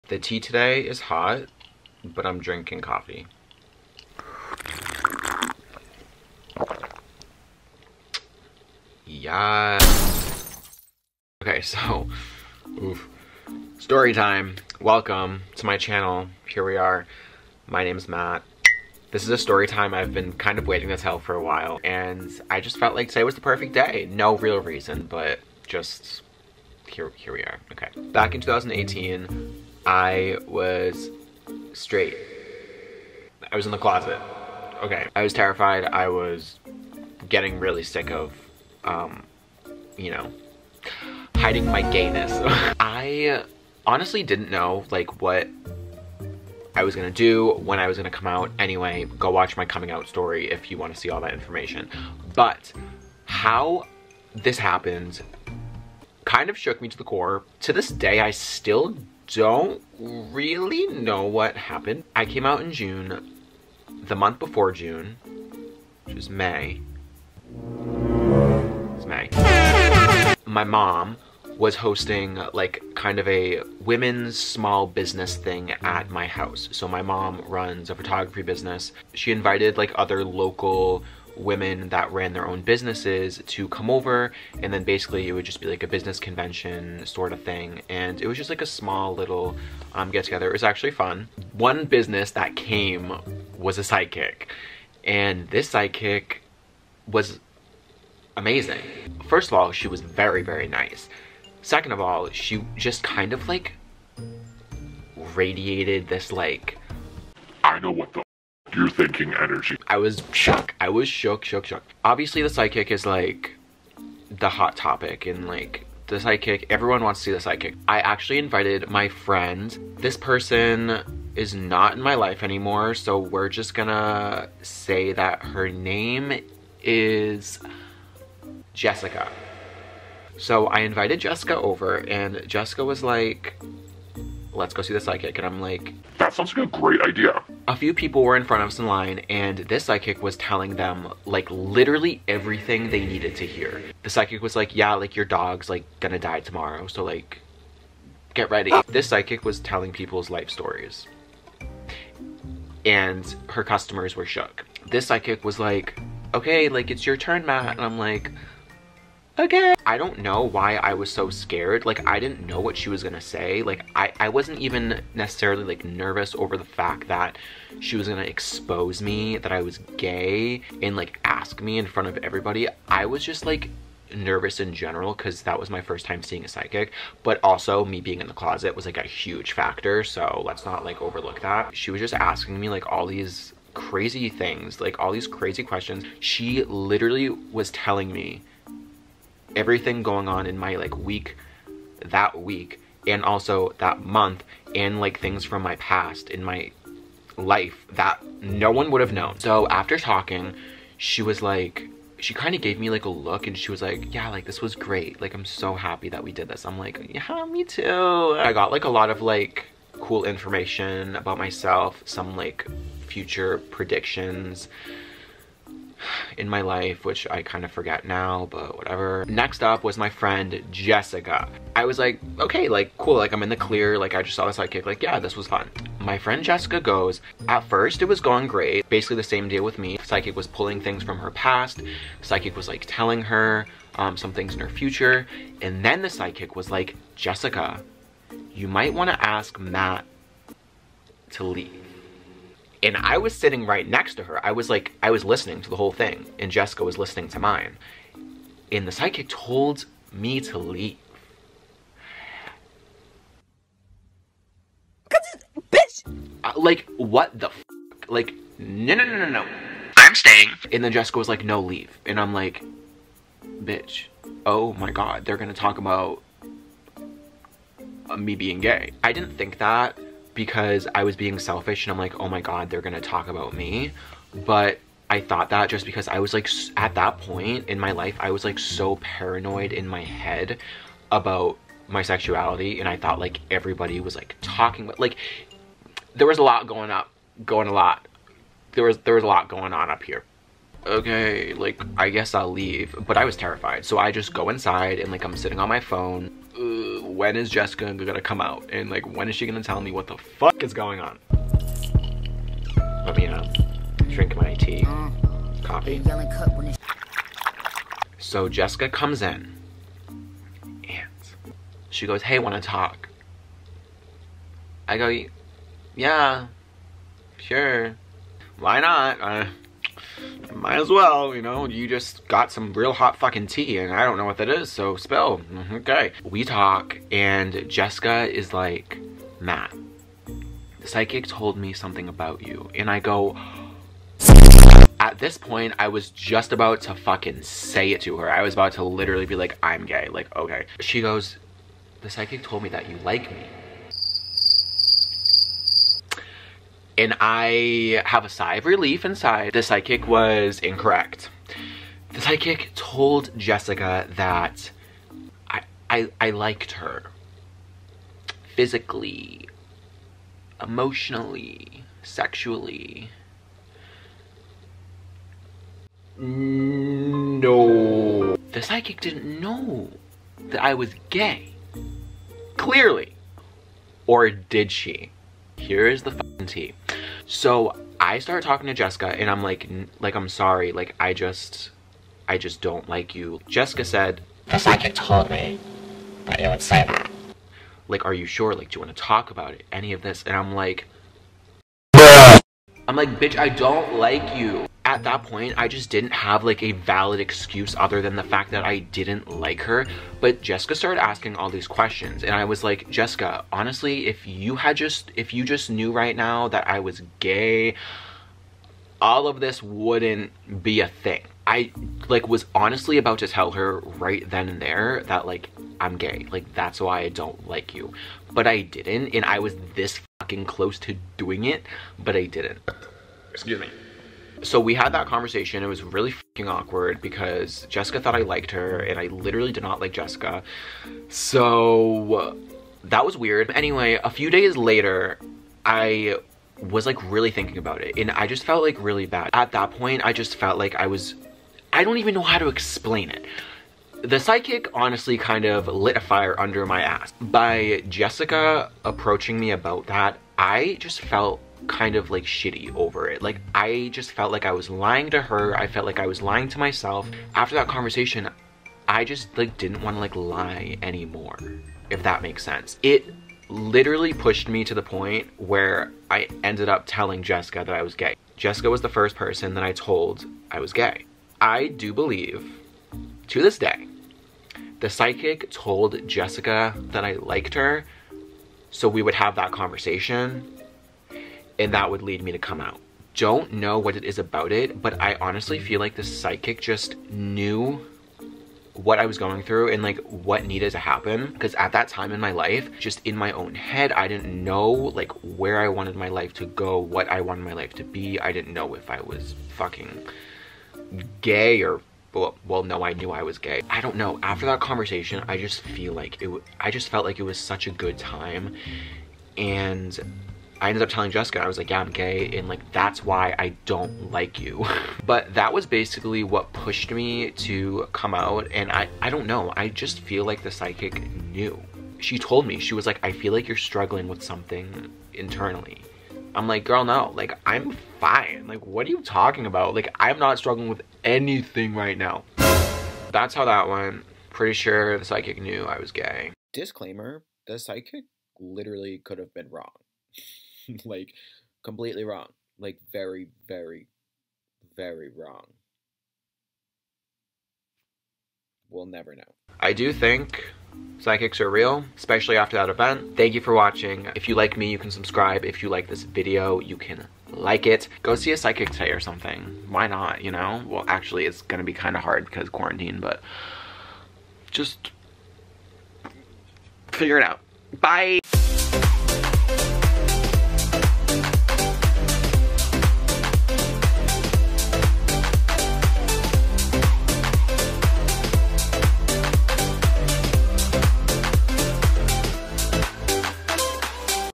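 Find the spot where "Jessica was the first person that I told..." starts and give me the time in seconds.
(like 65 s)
468 s.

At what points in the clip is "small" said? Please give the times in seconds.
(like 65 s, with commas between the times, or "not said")
74 s, 88 s.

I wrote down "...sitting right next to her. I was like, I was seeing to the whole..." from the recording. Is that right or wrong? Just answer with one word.
wrong.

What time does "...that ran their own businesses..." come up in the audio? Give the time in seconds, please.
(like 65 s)
81 s.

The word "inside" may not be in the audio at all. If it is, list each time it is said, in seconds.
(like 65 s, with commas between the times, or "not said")
294 s, 349 s.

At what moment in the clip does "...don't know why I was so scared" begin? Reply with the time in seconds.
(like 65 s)
159 s.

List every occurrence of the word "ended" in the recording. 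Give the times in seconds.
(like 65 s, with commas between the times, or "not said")
466 s, 510 s.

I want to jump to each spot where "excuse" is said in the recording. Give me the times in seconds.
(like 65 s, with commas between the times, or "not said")
397 s, 423 s.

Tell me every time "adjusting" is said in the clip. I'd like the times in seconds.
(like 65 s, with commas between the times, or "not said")
not said.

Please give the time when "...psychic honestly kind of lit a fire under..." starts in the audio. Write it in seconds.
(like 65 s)
444 s.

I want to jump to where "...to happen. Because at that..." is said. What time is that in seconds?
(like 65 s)
490 s.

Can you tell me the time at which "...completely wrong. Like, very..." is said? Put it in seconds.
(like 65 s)
541 s.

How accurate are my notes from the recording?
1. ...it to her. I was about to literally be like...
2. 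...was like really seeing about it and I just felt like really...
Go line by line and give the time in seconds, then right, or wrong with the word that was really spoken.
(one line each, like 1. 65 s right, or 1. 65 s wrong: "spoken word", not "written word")
1. 337 s right
2. 436 s wrong: "thinking", not "seeing".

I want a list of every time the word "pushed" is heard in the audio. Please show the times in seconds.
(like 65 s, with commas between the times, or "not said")
464 s, 516 s.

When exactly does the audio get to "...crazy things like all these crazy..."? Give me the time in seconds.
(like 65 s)
183 s.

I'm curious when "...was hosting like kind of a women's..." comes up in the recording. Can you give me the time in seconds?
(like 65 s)
71 s.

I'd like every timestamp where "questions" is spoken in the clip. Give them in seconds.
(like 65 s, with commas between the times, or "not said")
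185 s, 401 s.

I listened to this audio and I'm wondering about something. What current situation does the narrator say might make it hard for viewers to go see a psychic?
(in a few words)
quarantine.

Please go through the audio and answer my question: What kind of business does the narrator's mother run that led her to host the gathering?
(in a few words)
photography business.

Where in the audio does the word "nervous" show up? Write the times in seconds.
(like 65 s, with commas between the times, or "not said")
165 s, 174 s.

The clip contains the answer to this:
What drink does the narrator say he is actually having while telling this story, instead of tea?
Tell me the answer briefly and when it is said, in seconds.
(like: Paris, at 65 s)
coffee, at 2 s.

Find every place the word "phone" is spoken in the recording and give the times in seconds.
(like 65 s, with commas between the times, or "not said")
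295 s.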